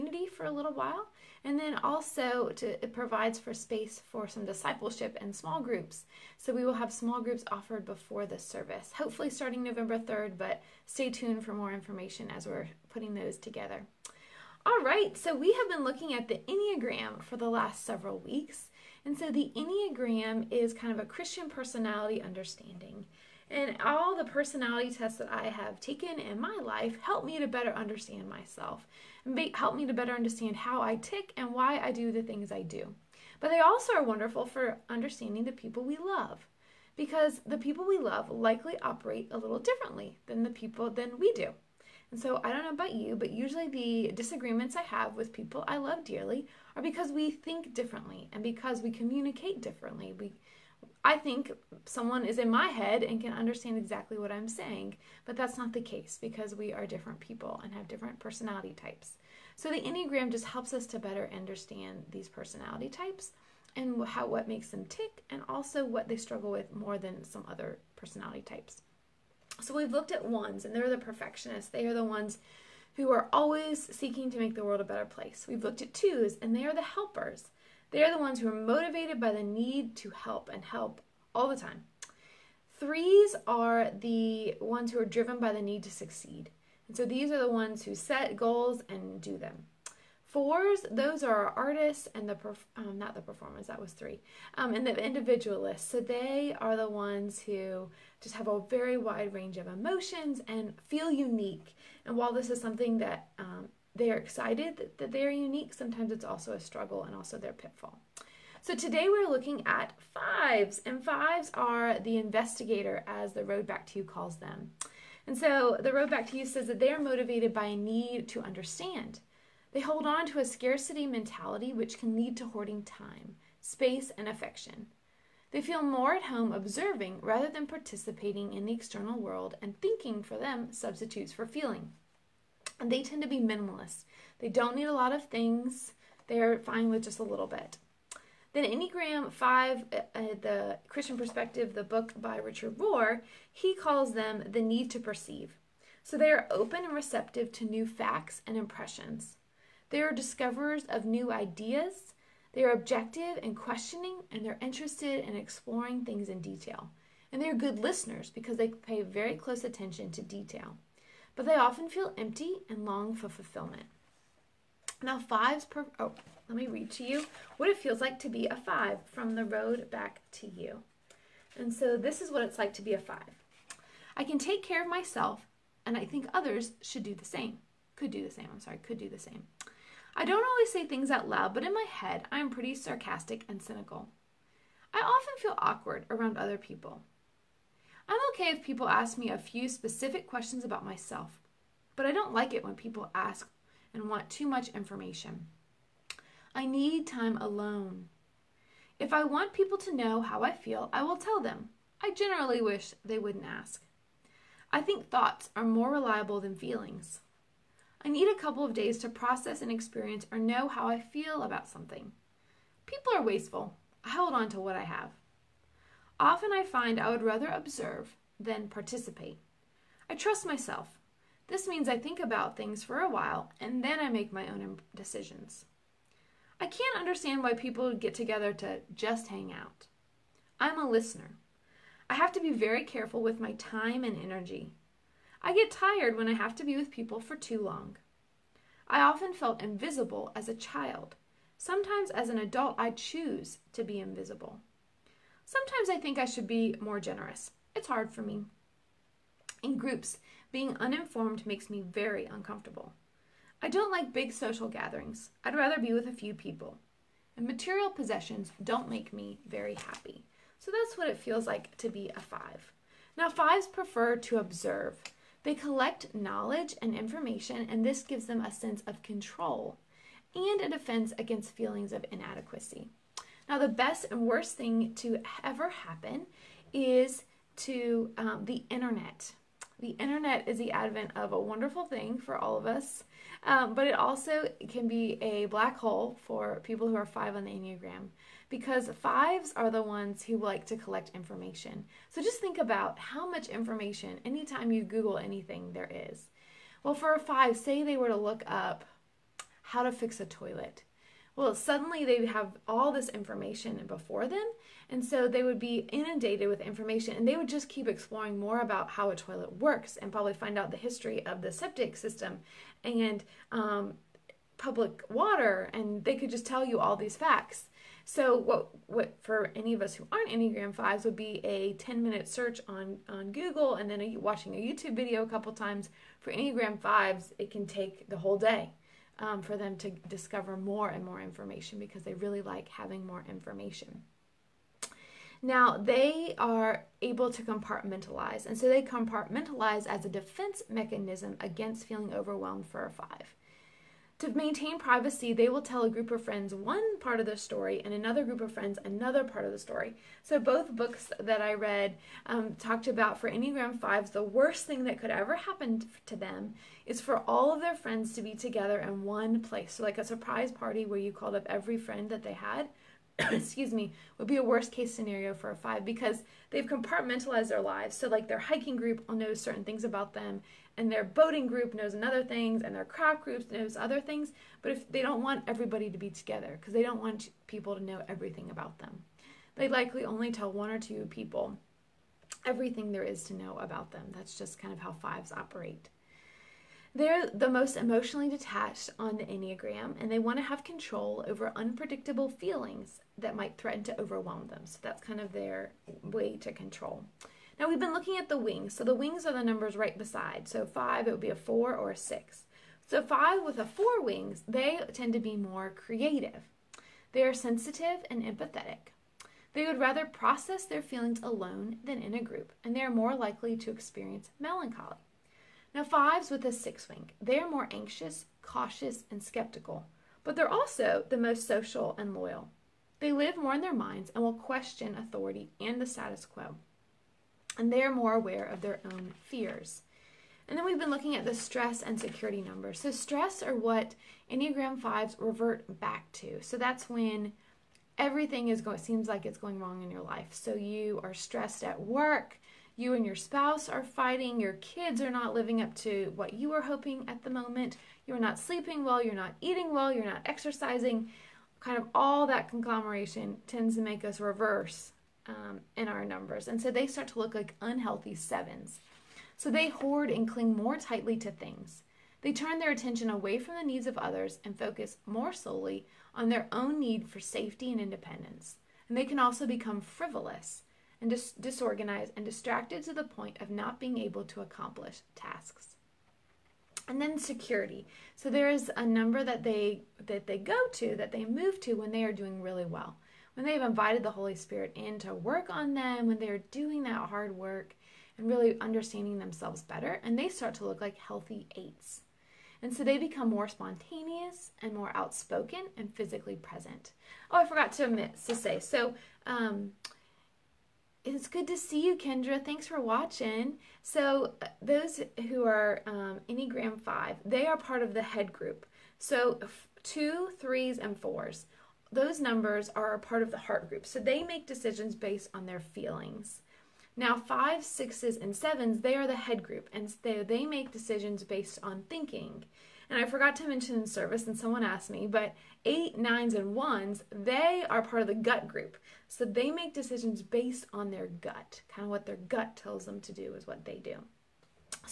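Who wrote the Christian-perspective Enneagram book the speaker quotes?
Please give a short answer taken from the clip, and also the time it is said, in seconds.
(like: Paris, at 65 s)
Richard Rohr, at 142 s.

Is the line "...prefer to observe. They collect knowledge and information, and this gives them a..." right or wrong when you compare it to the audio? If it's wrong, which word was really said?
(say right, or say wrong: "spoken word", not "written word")
right.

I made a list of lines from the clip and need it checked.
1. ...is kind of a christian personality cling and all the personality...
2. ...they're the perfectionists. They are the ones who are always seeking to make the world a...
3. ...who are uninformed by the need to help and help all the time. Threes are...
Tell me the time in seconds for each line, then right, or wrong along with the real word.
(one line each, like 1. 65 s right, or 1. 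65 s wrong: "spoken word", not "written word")
1. 20 s wrong: "understanding", not "cling"
2. 70 s right
3. 78 s wrong: "motivated", not "uninformed".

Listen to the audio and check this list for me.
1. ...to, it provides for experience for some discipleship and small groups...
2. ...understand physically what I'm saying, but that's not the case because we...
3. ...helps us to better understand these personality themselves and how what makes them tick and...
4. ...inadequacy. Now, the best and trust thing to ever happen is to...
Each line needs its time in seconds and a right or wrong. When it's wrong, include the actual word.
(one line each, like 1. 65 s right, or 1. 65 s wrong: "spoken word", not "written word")
1. 2 s wrong: "space", not "experience"
2. 53 s wrong: "exactly", not "physically"
3. 60 s wrong: "types", not "themselves"
4. 272 s wrong: "worst", not "trust".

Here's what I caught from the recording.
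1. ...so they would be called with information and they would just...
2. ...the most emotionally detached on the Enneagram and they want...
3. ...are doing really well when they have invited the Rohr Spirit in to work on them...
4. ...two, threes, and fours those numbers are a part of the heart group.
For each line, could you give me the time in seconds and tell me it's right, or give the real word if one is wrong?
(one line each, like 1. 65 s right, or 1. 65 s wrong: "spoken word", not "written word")
1. 305 s wrong: "inundated", not "called"
2. 387 s right
3. 482 s wrong: "Holy", not "Rohr"
4. 509 s right.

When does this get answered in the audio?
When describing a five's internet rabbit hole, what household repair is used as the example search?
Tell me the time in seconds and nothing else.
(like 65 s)
299 s.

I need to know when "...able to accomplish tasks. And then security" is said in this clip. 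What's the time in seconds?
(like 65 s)
473 s.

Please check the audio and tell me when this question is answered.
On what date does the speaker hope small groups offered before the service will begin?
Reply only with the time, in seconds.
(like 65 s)
9 s.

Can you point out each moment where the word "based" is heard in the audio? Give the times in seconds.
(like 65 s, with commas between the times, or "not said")
514 s, 521 s, 530 s.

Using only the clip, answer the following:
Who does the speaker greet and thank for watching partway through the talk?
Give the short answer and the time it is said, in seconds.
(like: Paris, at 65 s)
Kendra, at 501 s.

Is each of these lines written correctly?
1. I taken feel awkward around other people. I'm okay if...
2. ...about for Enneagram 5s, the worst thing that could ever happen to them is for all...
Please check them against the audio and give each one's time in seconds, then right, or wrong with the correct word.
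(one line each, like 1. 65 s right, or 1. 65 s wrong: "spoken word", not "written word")
1. 184 s wrong: "often", not "taken"
2. 352 s right.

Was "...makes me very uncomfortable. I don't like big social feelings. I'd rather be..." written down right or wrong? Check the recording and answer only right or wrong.
wrong.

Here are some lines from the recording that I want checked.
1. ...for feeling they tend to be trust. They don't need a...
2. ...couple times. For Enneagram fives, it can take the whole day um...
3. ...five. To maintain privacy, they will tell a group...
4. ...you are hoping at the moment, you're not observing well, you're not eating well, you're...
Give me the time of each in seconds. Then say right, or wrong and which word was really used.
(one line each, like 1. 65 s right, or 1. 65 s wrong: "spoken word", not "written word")
1. 131 s wrong: "minimalist", not "trust"
2. 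325 s right
3. 342 s right
4. 446 s wrong: "sleeping", not "observing".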